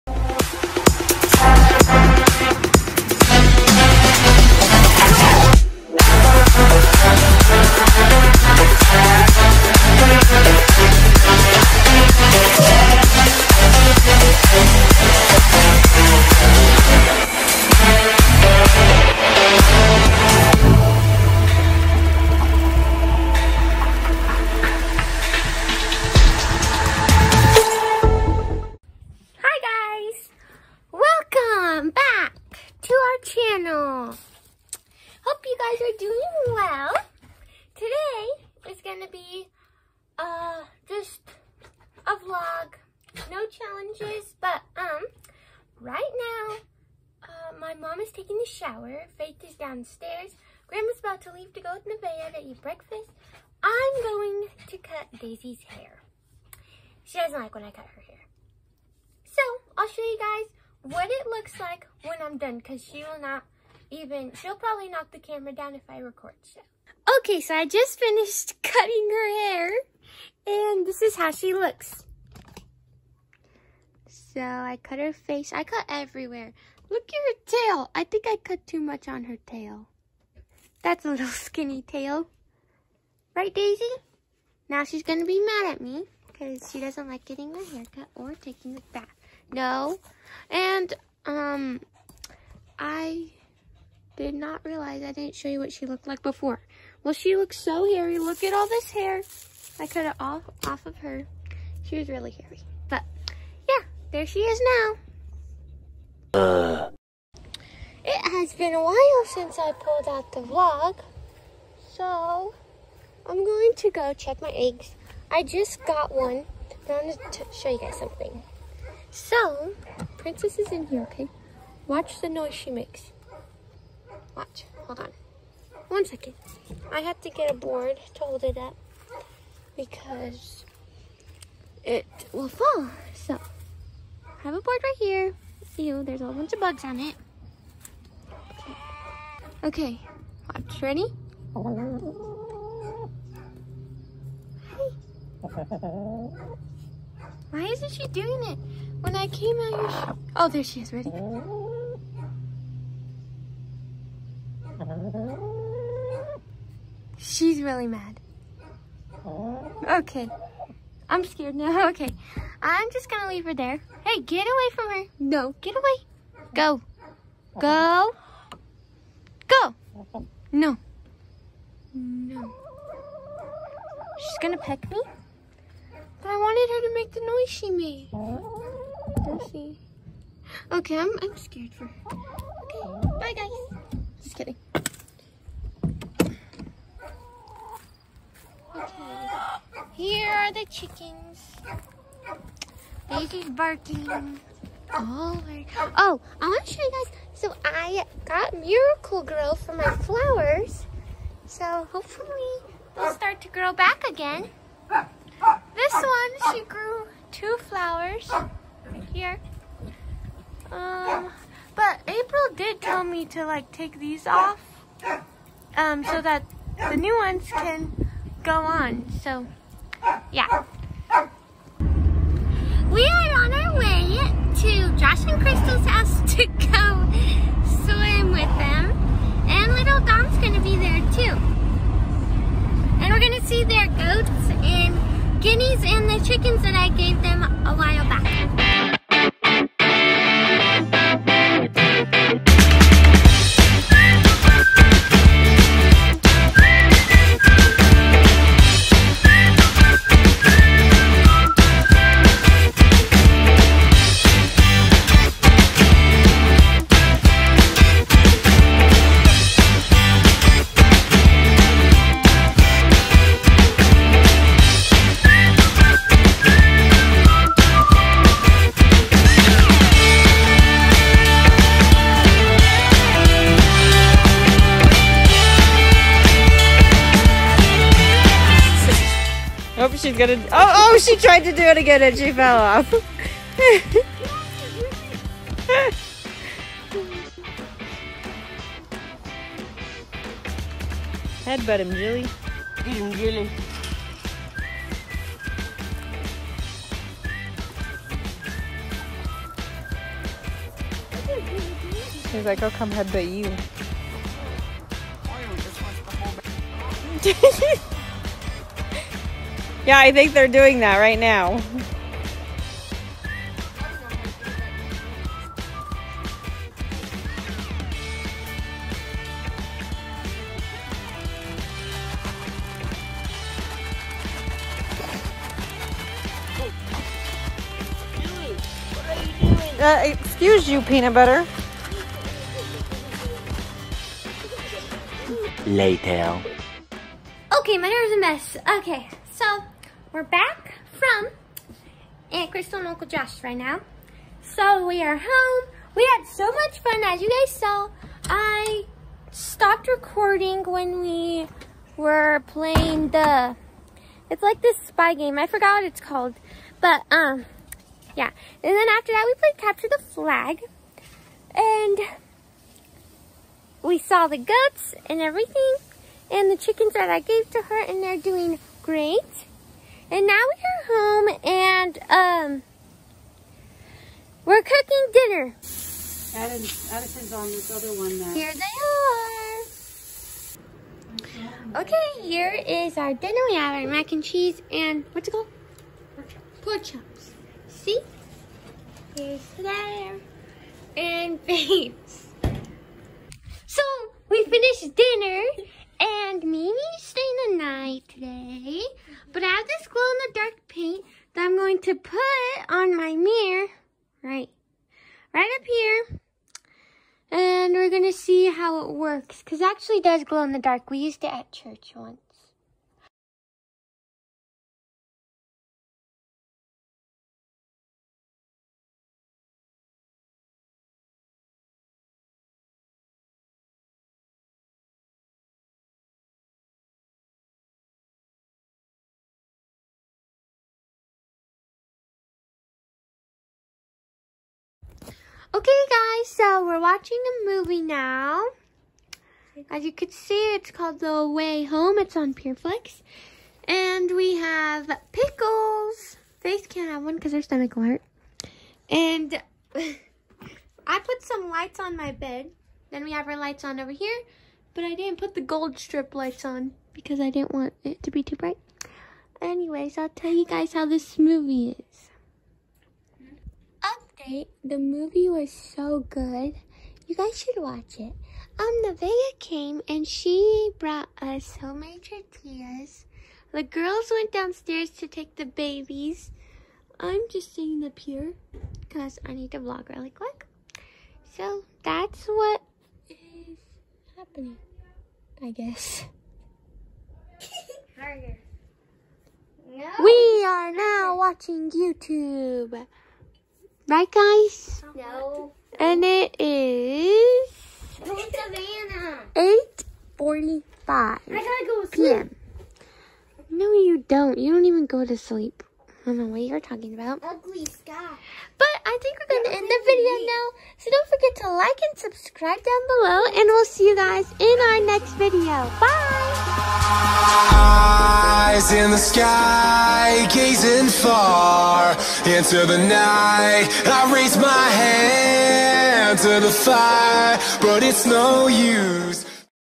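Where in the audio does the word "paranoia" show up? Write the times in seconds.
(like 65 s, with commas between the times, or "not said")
not said.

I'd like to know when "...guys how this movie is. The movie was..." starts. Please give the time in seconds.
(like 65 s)
460 s.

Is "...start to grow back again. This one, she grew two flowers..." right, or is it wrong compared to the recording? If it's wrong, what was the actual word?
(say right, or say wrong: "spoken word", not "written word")
right.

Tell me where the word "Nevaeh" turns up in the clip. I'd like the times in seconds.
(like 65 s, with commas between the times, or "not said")
52 s, 468 s.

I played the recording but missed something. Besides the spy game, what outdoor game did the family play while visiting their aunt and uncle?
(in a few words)
Capture the Flag.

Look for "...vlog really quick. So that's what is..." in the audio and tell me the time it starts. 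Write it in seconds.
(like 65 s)
479 s.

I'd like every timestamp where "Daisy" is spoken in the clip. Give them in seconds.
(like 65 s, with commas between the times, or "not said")
55 s, 83 s, 193 s.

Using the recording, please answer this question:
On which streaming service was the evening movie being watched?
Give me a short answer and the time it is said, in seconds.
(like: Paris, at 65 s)
Pureflix, at 442 s.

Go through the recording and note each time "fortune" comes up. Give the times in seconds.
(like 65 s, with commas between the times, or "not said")
not said.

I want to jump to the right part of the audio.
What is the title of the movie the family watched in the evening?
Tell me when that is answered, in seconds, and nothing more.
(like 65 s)
441 s.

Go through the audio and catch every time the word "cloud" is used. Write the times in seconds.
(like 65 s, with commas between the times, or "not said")
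not said.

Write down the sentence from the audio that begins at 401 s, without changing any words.
to put on my mirror, right, right up here.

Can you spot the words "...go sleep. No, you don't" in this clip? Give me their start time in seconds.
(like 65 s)
501 s.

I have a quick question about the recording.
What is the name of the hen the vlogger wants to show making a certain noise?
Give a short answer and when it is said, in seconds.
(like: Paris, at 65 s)
Princess, at 120 s.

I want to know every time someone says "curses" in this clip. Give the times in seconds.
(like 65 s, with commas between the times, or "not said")
not said.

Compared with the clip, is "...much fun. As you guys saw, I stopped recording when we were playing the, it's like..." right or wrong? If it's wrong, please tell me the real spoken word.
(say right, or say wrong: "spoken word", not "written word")
right.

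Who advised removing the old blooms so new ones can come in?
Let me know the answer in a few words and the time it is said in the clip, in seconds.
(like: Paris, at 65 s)
April, at 212 s.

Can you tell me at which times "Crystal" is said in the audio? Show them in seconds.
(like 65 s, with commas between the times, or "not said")
225 s, 342 s.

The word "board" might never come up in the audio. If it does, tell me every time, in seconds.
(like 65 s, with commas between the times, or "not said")
127 s, 134 s.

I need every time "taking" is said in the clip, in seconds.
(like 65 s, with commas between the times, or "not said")
48 s, 88 s.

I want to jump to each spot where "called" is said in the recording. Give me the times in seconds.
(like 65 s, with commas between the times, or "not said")
356 s, 385 s, 440 s.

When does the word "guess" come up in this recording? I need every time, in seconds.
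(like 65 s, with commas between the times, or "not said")
485 s.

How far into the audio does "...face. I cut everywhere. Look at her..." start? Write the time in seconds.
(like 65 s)
75 s.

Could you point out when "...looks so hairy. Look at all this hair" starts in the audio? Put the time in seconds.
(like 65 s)
97 s.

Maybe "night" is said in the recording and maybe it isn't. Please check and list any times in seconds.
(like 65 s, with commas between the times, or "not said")
397 s, 522 s.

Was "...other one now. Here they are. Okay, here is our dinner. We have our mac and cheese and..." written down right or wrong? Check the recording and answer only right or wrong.
right.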